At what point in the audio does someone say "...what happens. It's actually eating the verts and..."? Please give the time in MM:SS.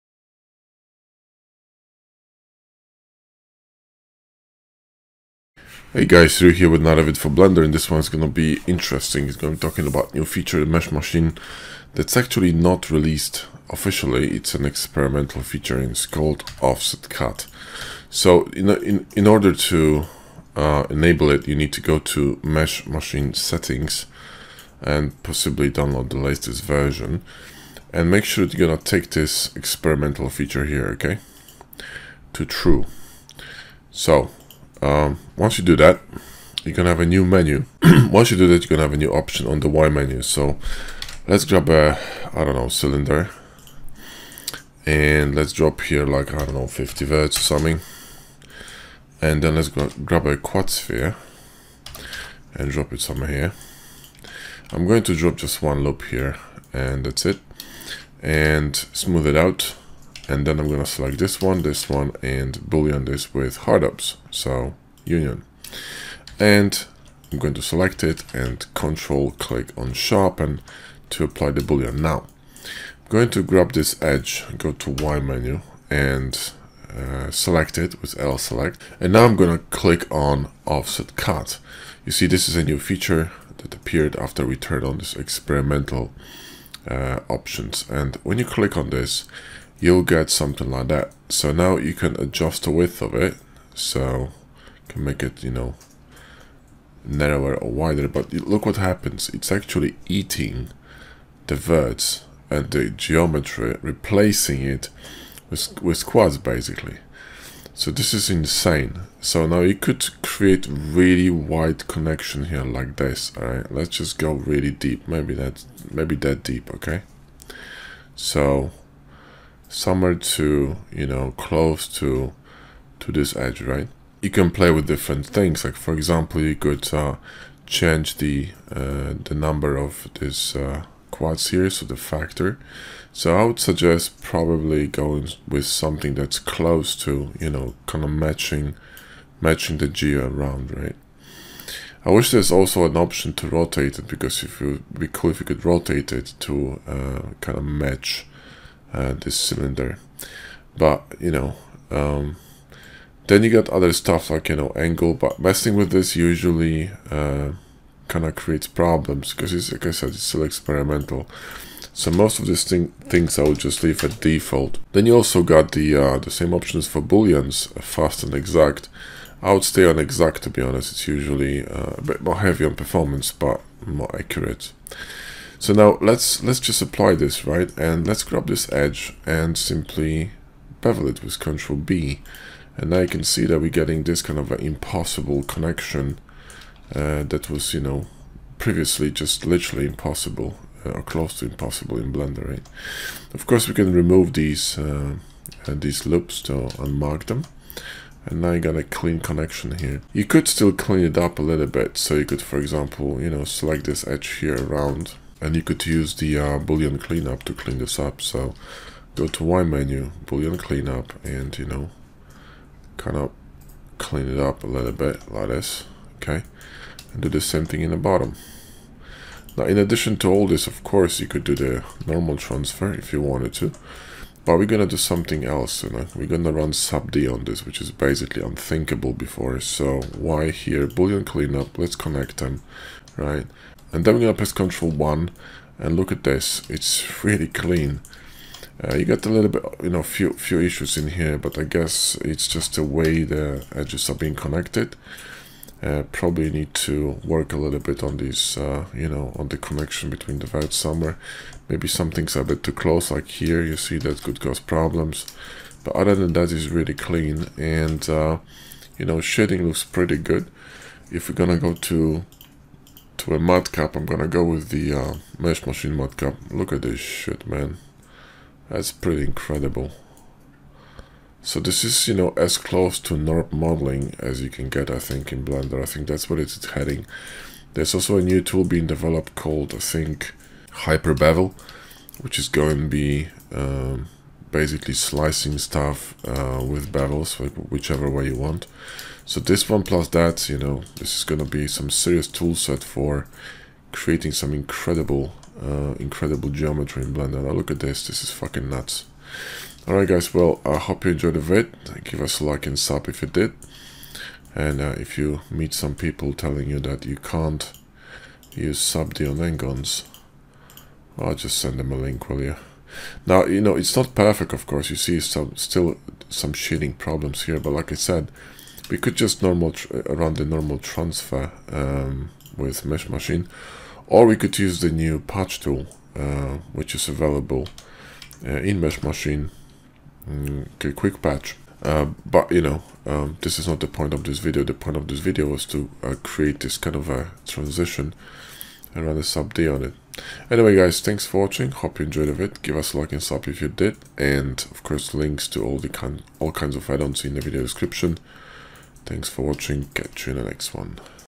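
01:38.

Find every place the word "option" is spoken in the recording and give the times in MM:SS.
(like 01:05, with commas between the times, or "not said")
00:39, 01:27, 02:22, 02:46.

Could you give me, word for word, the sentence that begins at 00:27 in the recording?
And make sure you're gonna take this experimental feature here, okay?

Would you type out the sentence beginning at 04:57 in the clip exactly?
Now look at this, this is fucking nuts.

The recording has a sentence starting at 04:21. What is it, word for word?
If we're gonna go to to a cap, I'm gonna go with the uh, mesh machine cap.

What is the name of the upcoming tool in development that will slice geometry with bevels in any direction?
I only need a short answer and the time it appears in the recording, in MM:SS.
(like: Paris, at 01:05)
Hyper Bevel, at 04:40.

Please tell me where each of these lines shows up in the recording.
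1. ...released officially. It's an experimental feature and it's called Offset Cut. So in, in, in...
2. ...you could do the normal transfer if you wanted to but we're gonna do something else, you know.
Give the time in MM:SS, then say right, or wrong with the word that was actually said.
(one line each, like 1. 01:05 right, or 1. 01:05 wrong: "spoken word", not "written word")
1. 00:12 right
2. 03:41 right.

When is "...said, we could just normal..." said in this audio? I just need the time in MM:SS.
05:17.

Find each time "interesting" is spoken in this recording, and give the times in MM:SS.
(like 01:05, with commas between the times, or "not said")
00:08.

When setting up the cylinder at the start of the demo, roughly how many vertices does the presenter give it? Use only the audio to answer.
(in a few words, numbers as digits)
50.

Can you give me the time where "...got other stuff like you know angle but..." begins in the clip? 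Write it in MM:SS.
02:33.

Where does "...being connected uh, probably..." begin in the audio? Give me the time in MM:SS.
04:04.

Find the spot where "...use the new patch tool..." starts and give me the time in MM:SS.
05:24.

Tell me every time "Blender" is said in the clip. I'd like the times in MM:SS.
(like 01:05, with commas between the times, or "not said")
00:07, 03:12, 04:35, 04:57.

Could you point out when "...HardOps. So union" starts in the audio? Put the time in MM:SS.
01:03.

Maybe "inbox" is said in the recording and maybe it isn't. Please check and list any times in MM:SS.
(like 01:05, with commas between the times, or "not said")
not said.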